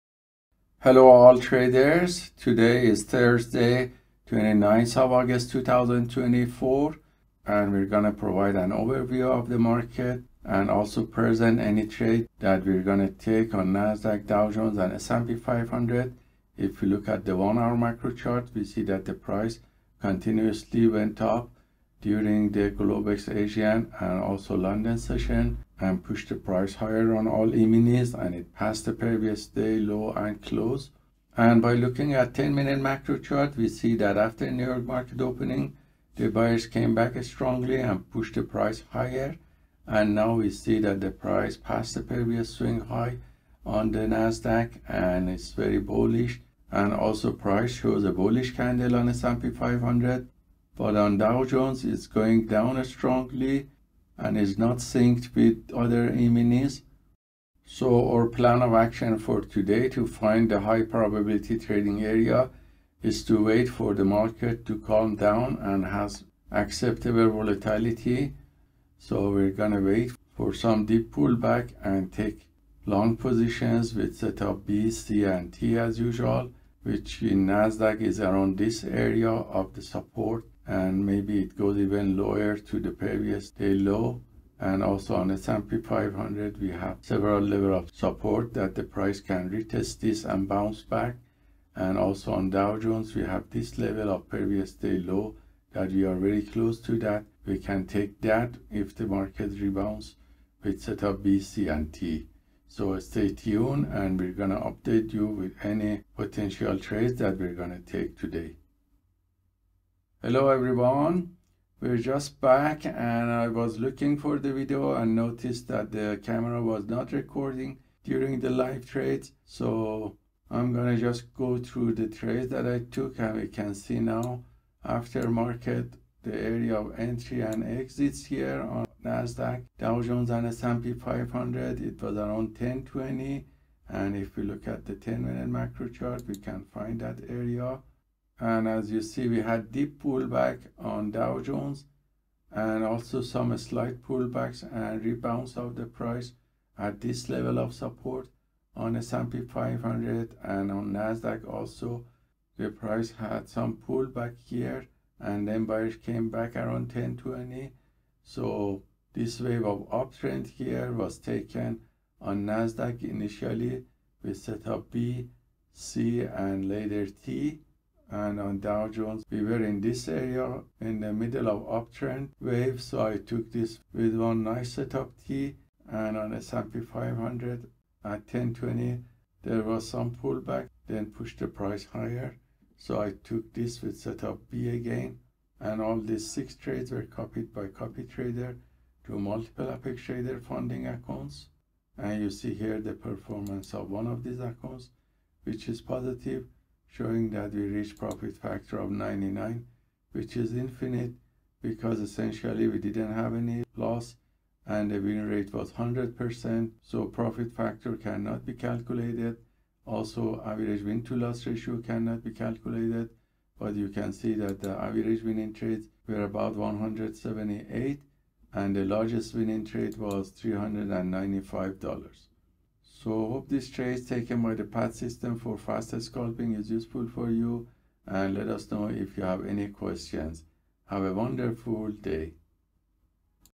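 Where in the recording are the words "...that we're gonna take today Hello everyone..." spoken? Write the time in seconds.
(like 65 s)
107 s.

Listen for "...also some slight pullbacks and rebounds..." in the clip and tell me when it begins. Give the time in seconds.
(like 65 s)
142 s.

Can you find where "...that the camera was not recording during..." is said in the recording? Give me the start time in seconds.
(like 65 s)
115 s.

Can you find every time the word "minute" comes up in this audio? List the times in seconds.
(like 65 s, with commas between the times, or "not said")
32 s, 135 s.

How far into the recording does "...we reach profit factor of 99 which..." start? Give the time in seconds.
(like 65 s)
197 s.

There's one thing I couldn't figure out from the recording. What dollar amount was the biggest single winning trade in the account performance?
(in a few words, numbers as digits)
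$395.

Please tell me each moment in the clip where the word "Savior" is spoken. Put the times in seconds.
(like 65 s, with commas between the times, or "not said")
not said.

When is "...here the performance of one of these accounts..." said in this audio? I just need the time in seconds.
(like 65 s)
192 s.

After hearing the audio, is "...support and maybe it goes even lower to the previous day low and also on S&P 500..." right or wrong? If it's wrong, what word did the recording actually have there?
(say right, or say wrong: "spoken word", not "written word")
right.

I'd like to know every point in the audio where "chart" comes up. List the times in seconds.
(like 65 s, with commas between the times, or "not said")
18 s, 33 s, 135 s.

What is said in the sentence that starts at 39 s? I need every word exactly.
And now we see that the price passed the previous swing high on the Nasdaq and it's very bullish.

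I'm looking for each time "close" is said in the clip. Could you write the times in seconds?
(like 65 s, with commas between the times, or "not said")
30 s, 96 s.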